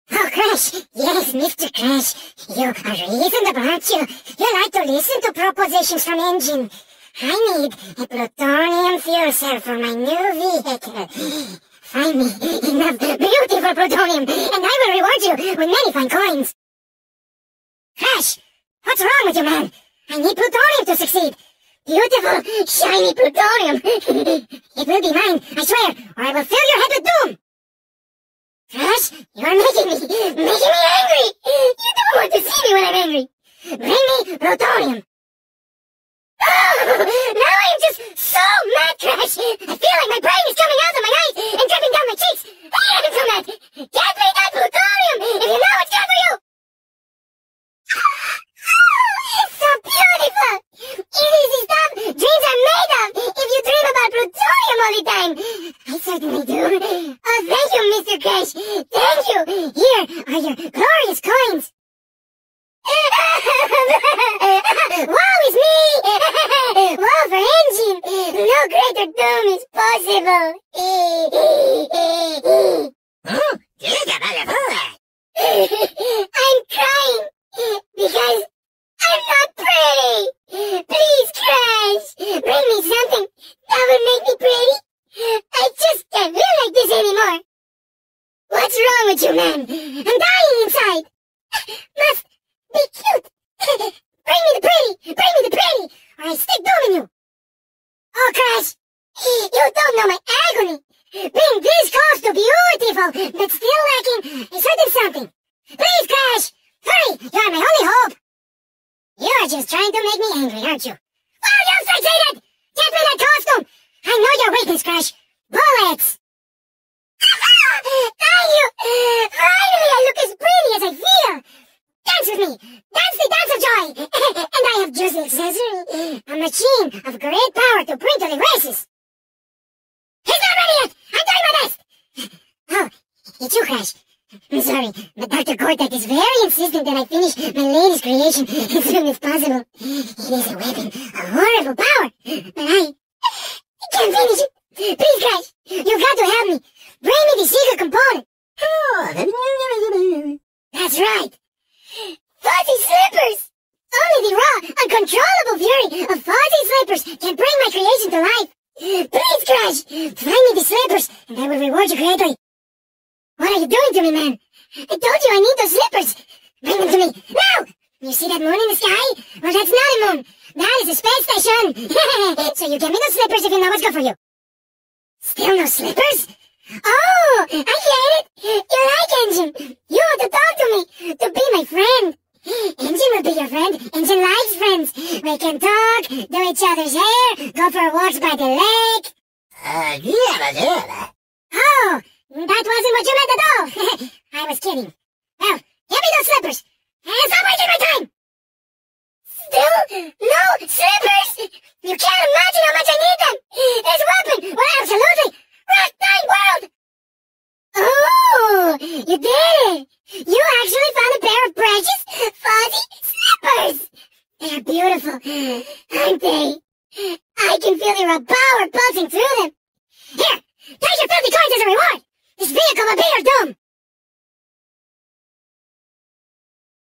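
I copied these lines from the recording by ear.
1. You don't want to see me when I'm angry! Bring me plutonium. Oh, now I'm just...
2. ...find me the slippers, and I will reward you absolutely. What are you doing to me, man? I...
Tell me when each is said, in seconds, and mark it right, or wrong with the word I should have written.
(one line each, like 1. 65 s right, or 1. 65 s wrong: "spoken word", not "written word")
1. 31 s right
2. 160 s wrong: "greatly", not "absolutely".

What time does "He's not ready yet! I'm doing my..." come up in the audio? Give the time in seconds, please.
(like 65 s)
130 s.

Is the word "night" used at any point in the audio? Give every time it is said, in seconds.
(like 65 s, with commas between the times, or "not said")
206 s.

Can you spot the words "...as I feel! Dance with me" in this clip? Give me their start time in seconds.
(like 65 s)
120 s.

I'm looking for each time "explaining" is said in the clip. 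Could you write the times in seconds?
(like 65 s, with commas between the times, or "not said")
not said.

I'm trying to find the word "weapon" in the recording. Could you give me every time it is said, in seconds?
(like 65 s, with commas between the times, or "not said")
140 s, 204 s.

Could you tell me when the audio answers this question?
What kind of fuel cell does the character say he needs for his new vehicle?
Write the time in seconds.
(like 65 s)
8 s.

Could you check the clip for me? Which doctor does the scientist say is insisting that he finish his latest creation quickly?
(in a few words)
Dr. Cortex.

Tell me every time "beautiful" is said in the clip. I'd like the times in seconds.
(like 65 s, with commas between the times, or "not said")
12 s, 21 s, 49 s, 102 s, 214 s.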